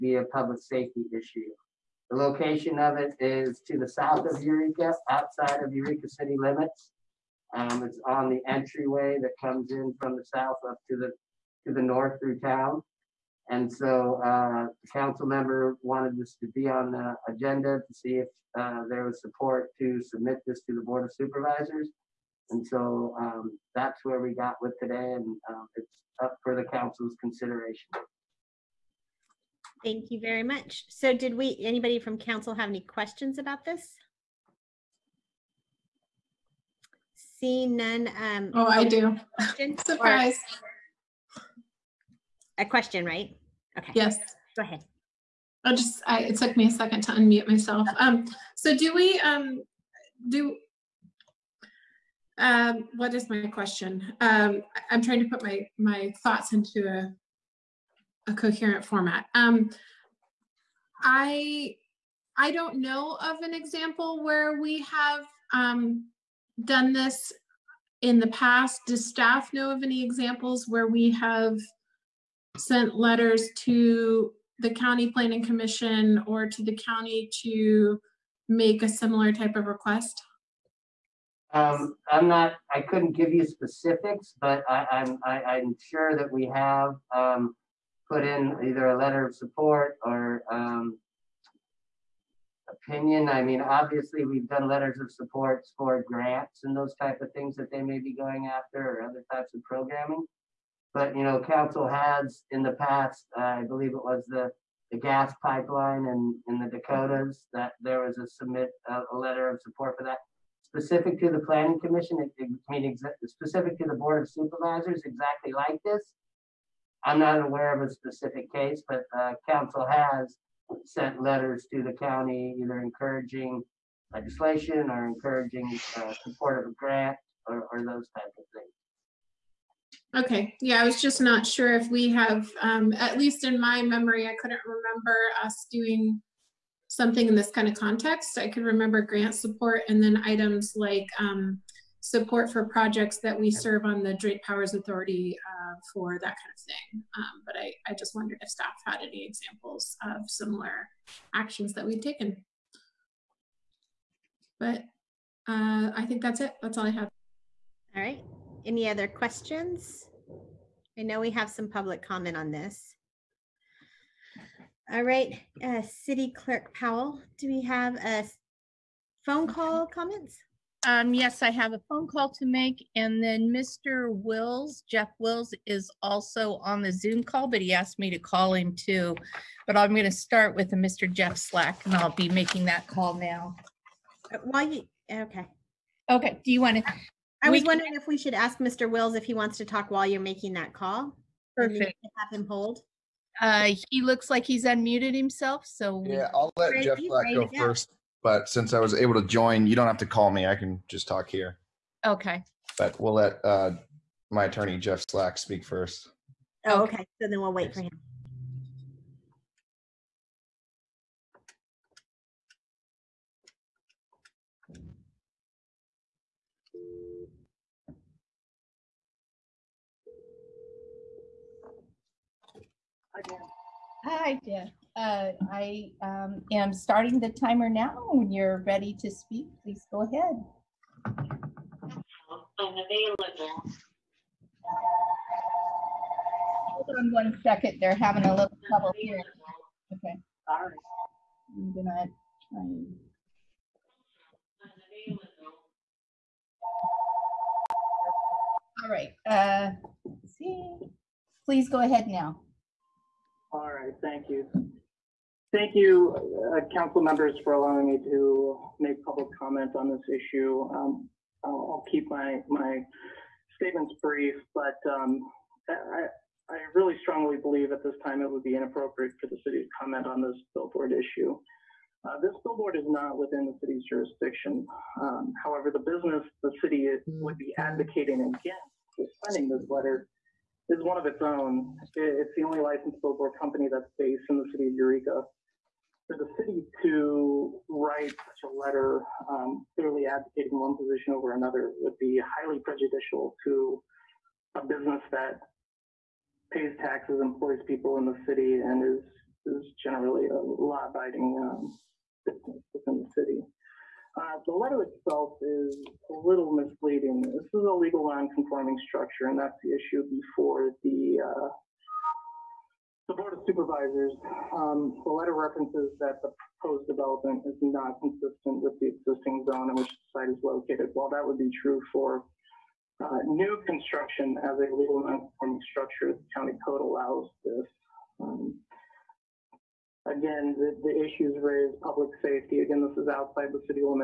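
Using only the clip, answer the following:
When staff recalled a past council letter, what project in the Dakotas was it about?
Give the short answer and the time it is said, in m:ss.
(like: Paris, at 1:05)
gas pipeline, at 1:44.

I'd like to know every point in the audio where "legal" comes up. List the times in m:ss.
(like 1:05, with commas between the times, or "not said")
5:07, 5:24.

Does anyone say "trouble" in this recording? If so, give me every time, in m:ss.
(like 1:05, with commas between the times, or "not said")
3:58.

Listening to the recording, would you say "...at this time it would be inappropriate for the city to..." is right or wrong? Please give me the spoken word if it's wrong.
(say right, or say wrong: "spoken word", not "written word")
right.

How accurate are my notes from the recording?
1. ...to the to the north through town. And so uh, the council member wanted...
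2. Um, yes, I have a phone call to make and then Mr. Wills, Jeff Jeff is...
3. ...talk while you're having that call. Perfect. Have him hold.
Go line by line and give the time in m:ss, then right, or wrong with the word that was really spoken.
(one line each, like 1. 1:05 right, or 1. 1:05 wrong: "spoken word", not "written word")
1. 0:10 right
2. 2:50 wrong: "Wills", not "Jeff"
3. 3:09 wrong: "making", not "having".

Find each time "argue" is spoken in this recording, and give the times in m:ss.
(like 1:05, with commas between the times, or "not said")
not said.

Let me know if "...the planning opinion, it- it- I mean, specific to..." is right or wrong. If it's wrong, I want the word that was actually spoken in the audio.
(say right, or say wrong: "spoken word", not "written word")
wrong: "commission", not "opinion".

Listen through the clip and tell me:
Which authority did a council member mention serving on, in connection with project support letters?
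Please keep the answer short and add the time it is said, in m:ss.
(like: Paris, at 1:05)
Drake Powers Authority, at 2:24.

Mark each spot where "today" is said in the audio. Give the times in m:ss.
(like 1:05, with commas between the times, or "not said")
0:24.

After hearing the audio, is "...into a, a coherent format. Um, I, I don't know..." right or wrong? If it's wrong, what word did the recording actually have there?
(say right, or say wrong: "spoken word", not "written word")
right.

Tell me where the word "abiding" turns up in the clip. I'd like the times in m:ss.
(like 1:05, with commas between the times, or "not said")
5:00.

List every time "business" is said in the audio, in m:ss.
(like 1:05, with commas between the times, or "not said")
4:35, 4:54, 5:02.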